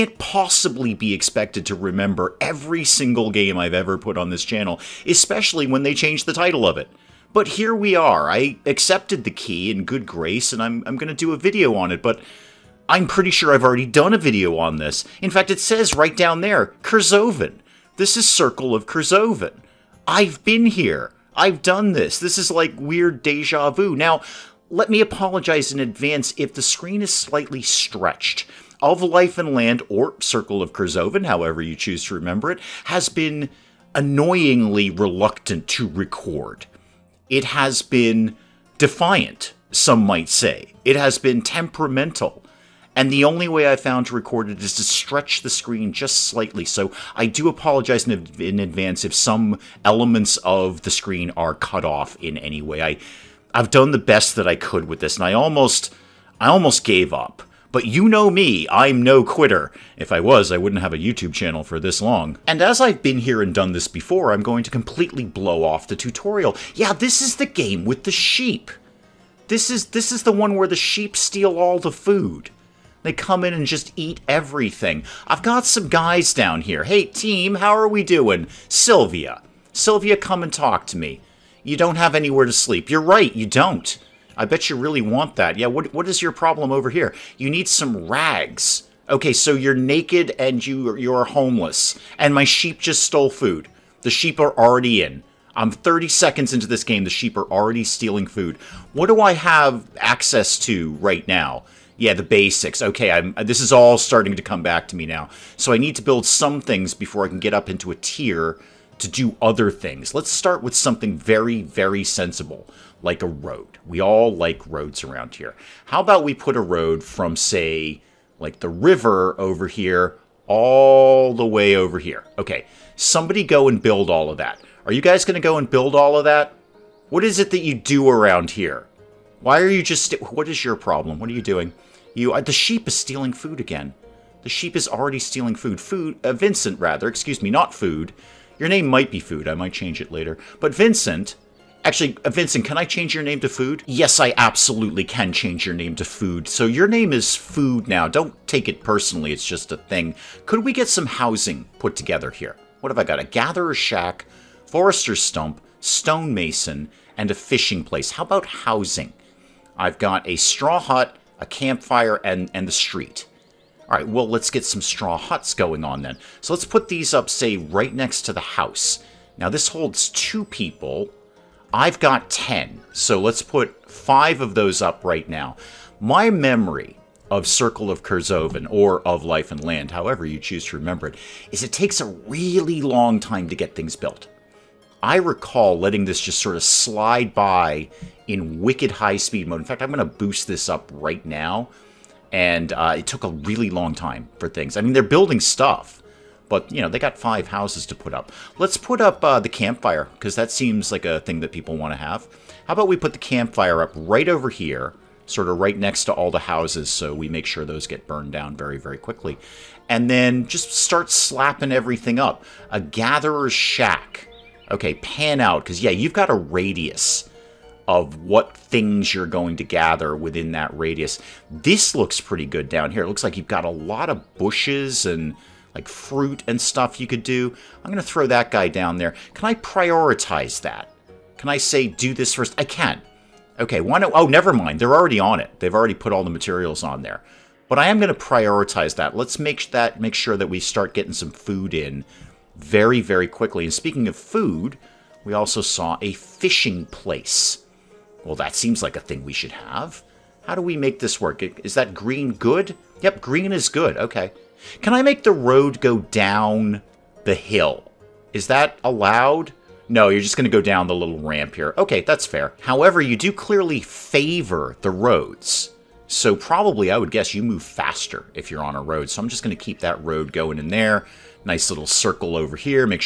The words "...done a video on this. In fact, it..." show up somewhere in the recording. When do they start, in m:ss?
0:13.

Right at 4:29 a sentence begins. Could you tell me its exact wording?
So I'm just going to keep that road going in there nice little circle over here.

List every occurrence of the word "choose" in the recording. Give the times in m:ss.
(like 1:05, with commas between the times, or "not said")
0:31, 3:00.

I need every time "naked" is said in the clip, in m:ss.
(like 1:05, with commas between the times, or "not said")
1:29.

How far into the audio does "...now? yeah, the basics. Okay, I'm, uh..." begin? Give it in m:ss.
1:41.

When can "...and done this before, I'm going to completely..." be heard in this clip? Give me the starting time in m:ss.
1:03.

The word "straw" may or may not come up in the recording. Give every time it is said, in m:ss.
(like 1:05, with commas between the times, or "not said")
2:40, 2:44.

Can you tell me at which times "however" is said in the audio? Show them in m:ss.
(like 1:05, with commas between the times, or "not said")
0:31, 2:59, 4:22.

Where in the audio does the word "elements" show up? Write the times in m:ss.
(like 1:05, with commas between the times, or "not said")
0:49.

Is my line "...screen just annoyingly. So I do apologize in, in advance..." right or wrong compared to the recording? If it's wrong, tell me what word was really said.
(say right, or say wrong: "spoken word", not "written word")
wrong: "slightly", not "annoyingly".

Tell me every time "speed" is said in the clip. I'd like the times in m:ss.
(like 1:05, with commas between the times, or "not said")
3:09.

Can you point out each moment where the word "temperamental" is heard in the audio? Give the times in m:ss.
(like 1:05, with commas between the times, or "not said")
0:41.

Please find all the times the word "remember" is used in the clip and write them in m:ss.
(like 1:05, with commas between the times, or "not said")
0:01, 0:32, 3:00.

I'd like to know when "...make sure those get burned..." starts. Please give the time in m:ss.
3:27.